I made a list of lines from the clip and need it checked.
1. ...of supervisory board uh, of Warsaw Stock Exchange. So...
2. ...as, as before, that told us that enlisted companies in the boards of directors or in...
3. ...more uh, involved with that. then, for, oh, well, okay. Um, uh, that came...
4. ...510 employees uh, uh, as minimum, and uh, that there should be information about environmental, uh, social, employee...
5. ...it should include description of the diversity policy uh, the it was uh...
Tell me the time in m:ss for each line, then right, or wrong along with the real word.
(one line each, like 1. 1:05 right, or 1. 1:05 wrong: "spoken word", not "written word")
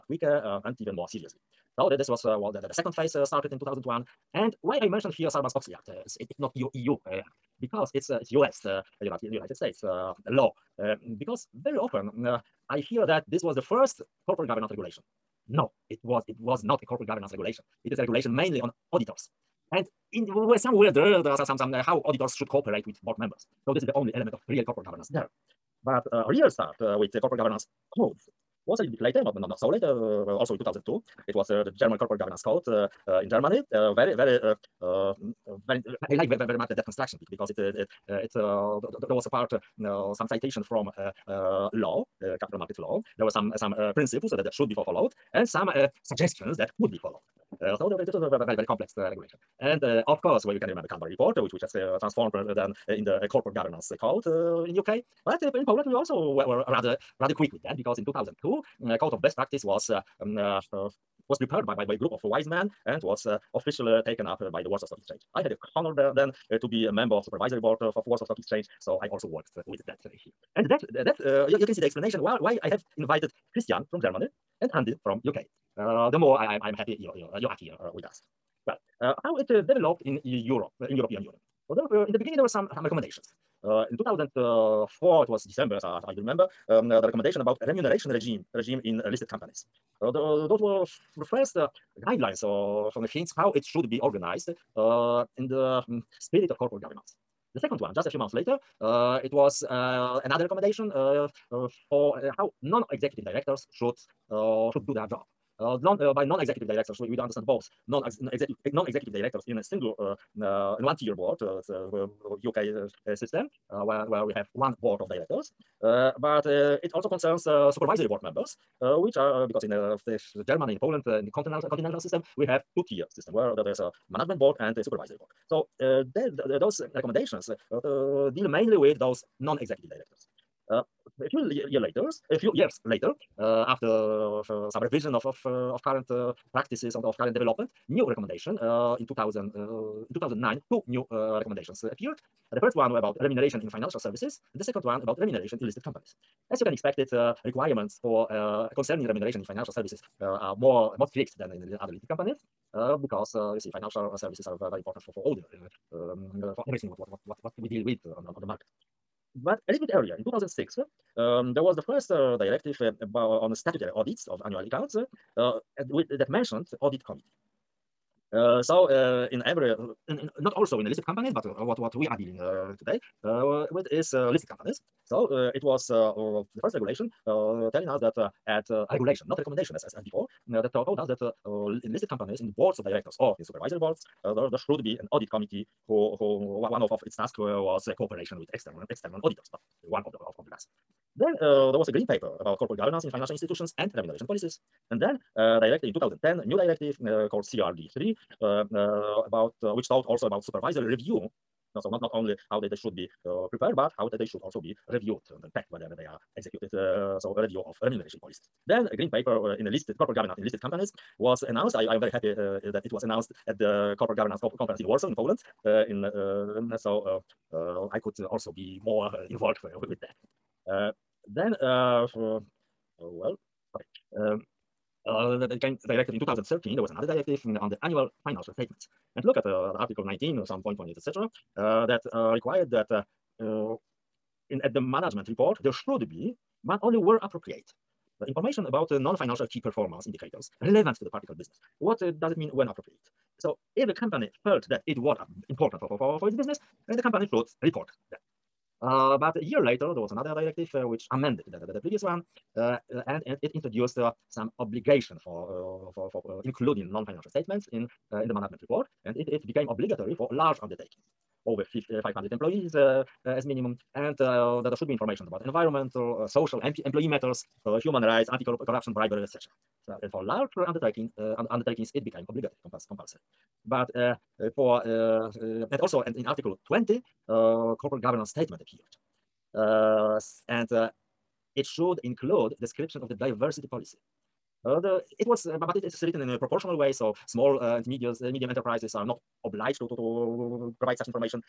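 1. 1:07 right
2. 2:59 right
3. 3:38 right
4. 4:22 wrong: "500", not "510"
5. 4:41 right.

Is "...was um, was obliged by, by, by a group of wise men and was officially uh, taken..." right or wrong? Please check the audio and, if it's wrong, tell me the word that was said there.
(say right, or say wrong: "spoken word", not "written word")
wrong: "prepared", not "obliged".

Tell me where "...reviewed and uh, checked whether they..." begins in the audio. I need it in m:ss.
3:24.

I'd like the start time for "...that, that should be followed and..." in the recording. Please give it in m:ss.
0:44.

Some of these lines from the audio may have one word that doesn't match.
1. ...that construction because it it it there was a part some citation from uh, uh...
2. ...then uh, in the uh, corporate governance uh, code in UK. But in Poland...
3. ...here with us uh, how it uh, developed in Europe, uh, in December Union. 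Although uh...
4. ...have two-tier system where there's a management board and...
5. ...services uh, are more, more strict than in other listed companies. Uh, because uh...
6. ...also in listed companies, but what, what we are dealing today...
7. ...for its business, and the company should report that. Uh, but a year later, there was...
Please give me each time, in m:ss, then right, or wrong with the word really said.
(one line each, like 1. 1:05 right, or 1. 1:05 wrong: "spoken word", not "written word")
1. 0:36 right
2. 0:52 right
3. 1:17 wrong: "European", not "December"
4. 2:02 right
5. 2:29 right
6. 2:50 right
7. 4:06 right.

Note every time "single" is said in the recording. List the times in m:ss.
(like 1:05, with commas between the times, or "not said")
1:49.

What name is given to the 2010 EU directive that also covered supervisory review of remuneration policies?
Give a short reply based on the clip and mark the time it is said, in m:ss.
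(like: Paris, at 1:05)
CRD3, at 3:17.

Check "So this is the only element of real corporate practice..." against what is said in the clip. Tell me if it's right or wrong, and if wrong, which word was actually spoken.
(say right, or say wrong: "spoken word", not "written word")
wrong: "governance", not "practice".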